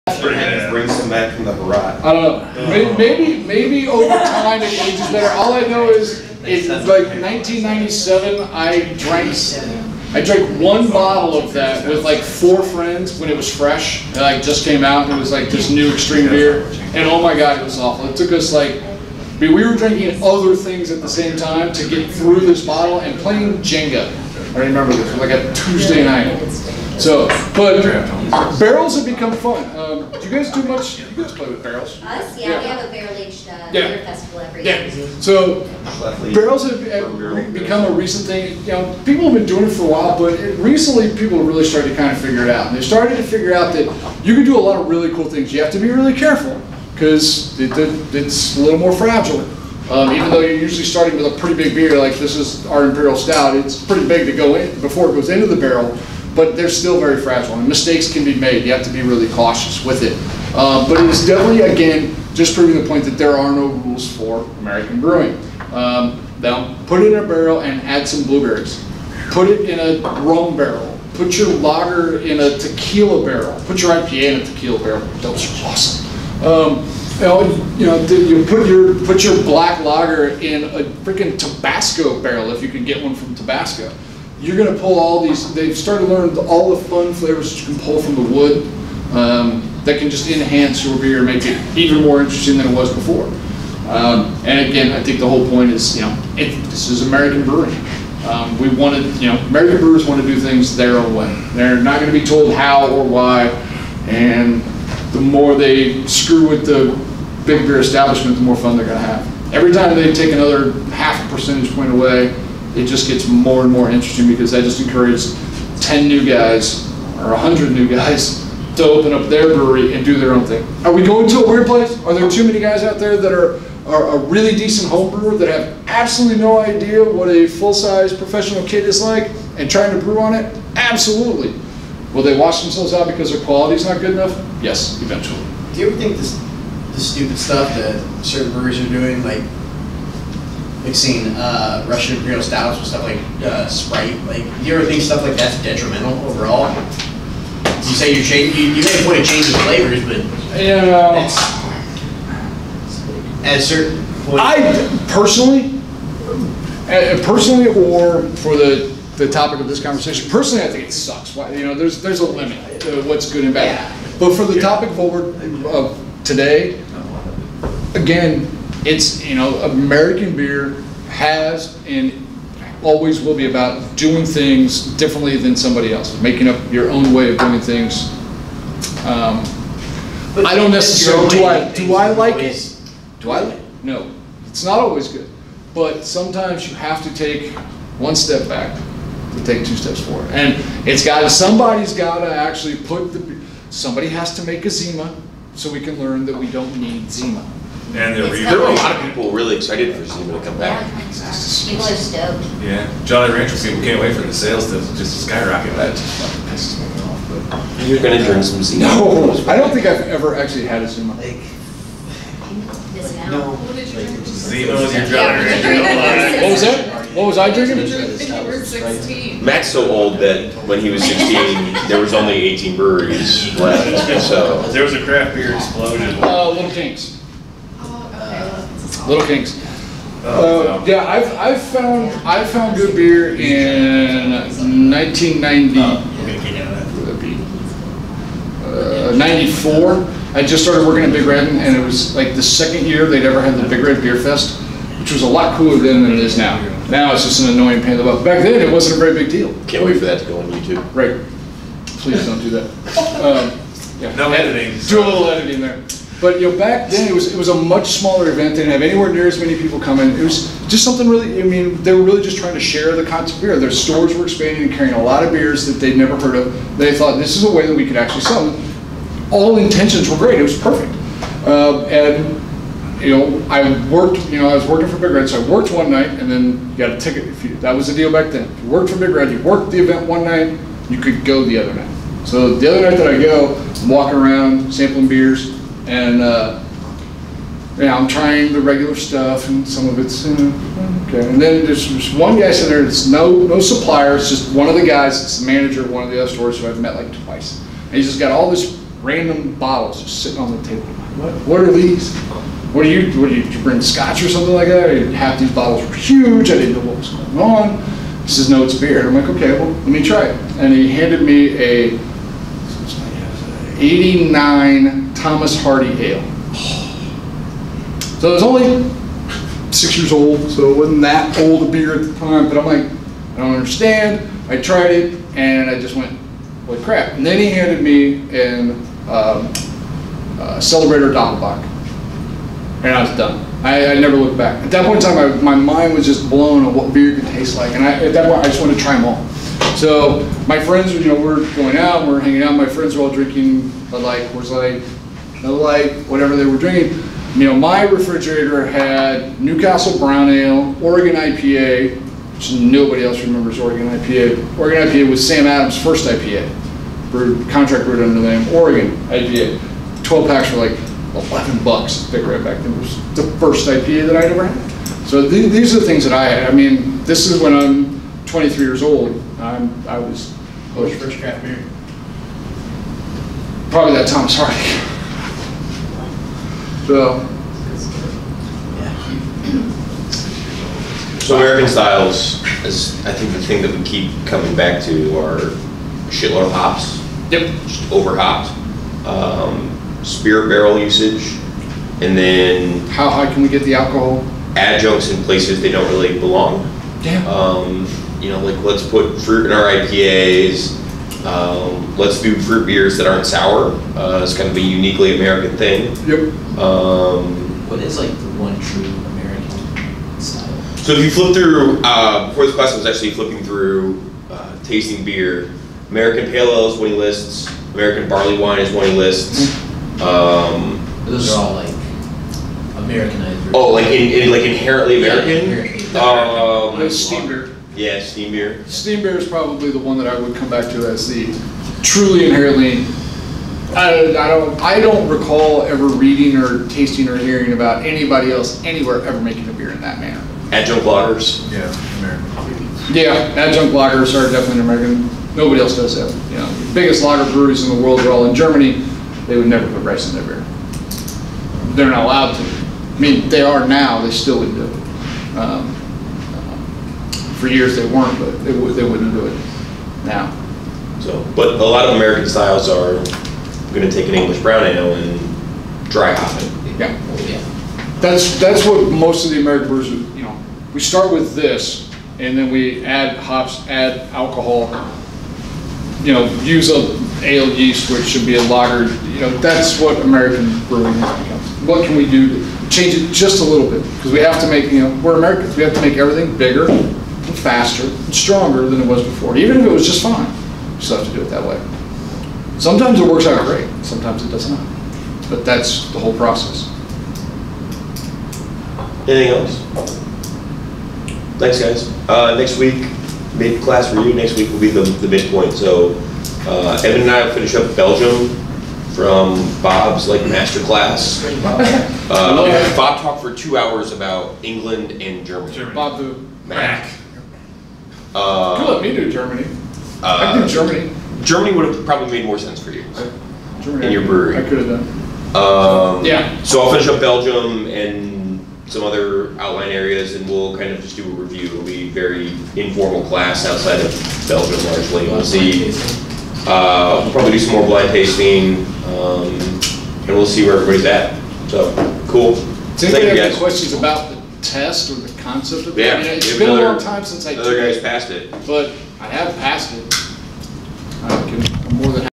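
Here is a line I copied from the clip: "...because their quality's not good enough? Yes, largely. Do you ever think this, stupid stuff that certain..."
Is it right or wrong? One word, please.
wrong.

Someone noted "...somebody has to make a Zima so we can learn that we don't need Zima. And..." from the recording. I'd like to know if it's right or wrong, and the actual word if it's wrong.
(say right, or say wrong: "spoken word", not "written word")
right.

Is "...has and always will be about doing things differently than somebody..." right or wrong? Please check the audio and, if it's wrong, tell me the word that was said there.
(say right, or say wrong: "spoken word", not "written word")
right.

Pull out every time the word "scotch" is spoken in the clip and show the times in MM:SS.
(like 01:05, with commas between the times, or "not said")
05:03.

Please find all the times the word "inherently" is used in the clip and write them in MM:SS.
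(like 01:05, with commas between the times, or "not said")
07:04, 07:12.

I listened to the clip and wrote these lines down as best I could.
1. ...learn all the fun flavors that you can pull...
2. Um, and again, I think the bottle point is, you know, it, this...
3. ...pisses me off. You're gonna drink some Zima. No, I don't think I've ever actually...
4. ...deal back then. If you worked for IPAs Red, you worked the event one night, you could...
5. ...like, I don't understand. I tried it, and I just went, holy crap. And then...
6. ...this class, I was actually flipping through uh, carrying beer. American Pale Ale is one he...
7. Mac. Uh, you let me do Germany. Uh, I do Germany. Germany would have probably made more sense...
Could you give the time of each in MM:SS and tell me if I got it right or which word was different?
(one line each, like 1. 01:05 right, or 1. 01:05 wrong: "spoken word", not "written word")
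1. 01:26 right
2. 01:33 wrong: "whole", not "bottle"
3. 03:26 right
4. 04:37 wrong: "Big", not "IPAs"
5. 05:22 right
6. 06:52 wrong: "tasting", not "carrying"
7. 08:36 right.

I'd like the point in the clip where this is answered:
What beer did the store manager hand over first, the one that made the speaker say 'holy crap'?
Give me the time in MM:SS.
05:13.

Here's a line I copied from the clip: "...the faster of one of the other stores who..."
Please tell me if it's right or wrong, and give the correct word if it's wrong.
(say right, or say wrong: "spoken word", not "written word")
wrong: "manager", not "faster".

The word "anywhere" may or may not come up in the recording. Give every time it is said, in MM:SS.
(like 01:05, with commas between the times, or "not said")
04:18, 07:18.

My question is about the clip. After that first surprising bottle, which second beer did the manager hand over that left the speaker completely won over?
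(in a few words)
Celebrator Doppelbock.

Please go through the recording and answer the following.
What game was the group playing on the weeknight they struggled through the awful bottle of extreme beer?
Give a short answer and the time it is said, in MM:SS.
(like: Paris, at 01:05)
Jenga, at 00:23.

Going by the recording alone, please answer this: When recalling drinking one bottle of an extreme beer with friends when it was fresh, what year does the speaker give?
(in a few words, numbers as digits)
1997.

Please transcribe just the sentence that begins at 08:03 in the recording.
Because we have to make, you know, we're Americans.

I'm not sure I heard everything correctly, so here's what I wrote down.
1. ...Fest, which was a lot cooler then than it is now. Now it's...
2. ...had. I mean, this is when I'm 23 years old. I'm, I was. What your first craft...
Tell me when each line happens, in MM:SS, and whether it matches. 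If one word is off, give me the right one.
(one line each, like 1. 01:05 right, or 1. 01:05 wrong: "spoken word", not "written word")
1. 04:04 right
2. 06:06 right.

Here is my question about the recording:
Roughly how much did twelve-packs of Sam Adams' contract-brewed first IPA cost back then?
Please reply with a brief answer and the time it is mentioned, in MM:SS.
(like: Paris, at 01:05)
11 bucks, at 06:01.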